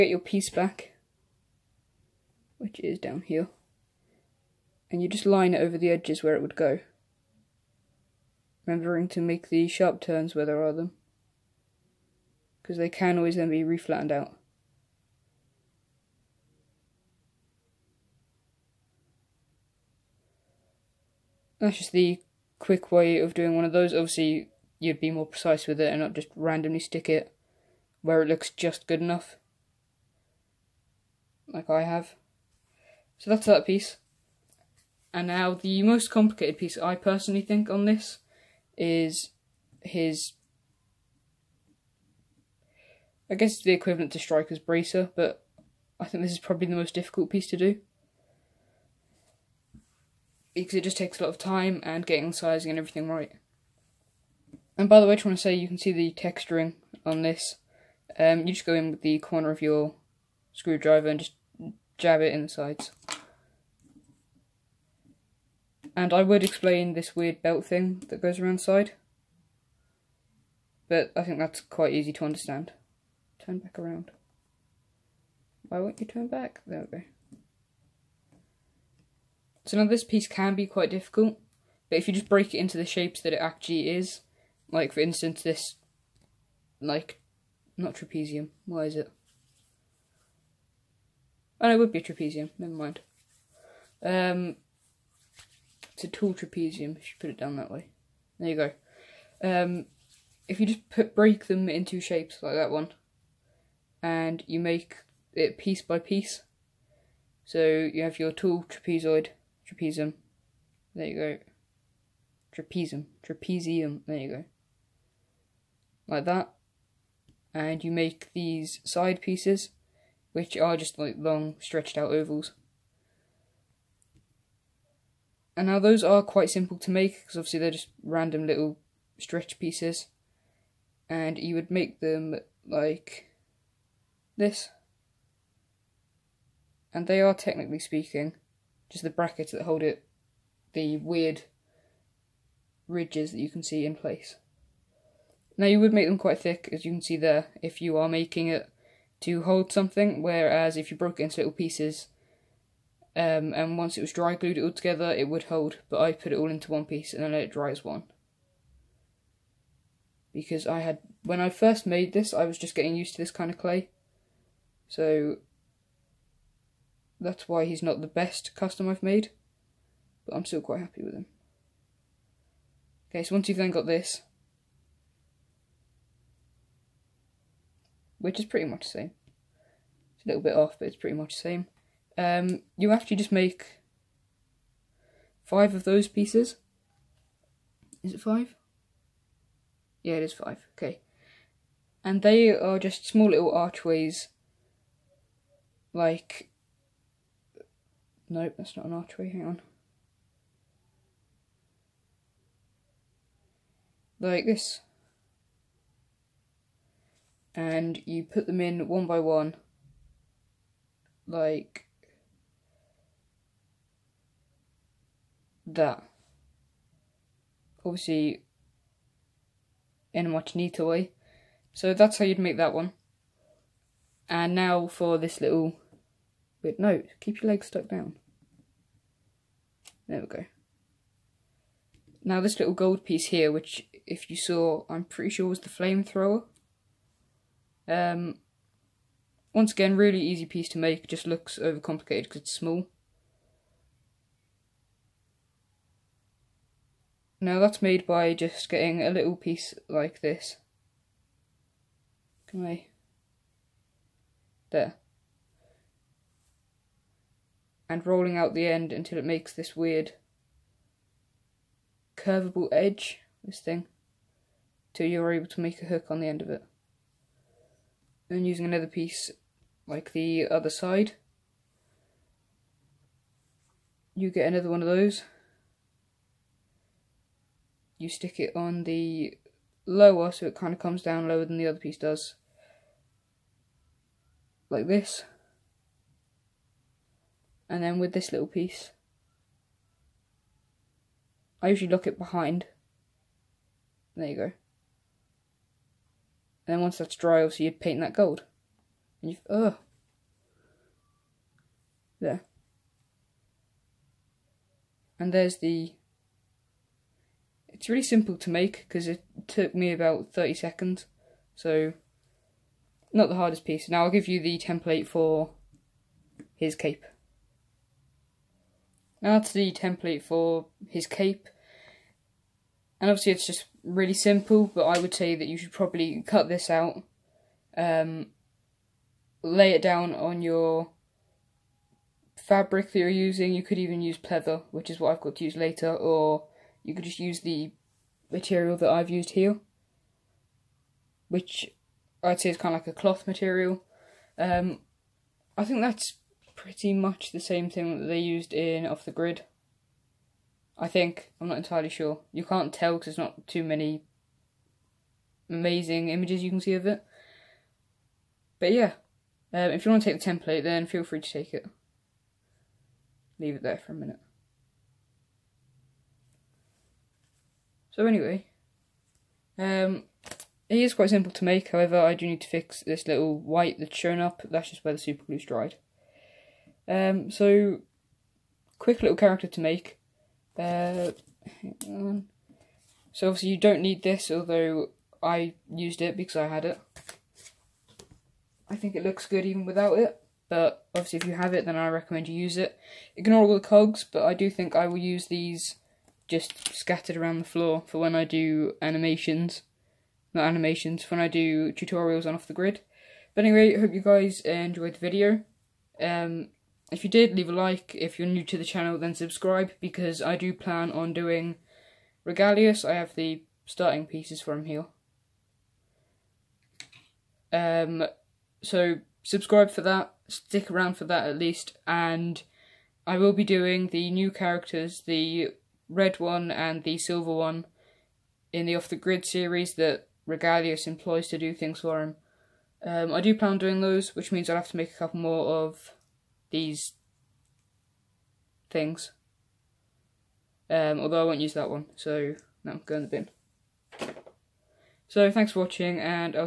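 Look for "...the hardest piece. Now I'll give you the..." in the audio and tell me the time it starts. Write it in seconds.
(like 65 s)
313 s.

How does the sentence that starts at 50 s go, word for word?
Because it just takes a lot of time and getting sizing and everything right.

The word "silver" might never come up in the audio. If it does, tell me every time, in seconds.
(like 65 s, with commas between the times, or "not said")
426 s.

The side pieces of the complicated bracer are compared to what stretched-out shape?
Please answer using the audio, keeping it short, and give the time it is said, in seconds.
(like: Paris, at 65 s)
Ovals, at 122 s.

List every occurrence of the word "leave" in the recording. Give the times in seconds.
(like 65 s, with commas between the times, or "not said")
363 s, 407 s.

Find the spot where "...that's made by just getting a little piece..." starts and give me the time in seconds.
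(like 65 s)
247 s.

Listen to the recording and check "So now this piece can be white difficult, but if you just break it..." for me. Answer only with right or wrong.
wrong.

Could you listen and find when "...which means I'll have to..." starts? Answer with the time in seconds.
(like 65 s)
434 s.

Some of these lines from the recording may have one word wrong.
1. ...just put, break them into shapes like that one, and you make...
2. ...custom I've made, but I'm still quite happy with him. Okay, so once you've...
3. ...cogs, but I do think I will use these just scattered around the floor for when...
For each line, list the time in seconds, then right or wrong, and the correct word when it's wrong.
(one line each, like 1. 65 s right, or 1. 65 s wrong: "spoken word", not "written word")
1. 100 s right
2. 168 s right
3. 393 s right.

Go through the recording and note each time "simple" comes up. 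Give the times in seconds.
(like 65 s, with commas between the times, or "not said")
126 s, 308 s, 324 s, 371 s.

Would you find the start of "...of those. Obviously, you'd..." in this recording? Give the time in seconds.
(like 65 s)
23 s.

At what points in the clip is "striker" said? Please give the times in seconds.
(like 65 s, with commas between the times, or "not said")
44 s.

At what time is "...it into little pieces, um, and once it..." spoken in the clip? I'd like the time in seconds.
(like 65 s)
151 s.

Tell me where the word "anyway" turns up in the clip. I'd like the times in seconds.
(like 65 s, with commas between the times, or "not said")
368 s, 403 s.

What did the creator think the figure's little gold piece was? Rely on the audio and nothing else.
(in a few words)
The flamethrower.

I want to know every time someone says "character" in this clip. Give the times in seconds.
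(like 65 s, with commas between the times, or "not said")
379 s, 424 s.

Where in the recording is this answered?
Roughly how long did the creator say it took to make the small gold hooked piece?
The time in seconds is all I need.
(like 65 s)
309 s.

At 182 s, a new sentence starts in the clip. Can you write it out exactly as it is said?
Um, you actually just make five of those pieces.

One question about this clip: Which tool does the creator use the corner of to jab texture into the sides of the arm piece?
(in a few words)
Screwdriver.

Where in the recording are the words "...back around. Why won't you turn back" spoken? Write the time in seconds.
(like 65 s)
73 s.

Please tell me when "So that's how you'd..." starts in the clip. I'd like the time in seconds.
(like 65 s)
221 s.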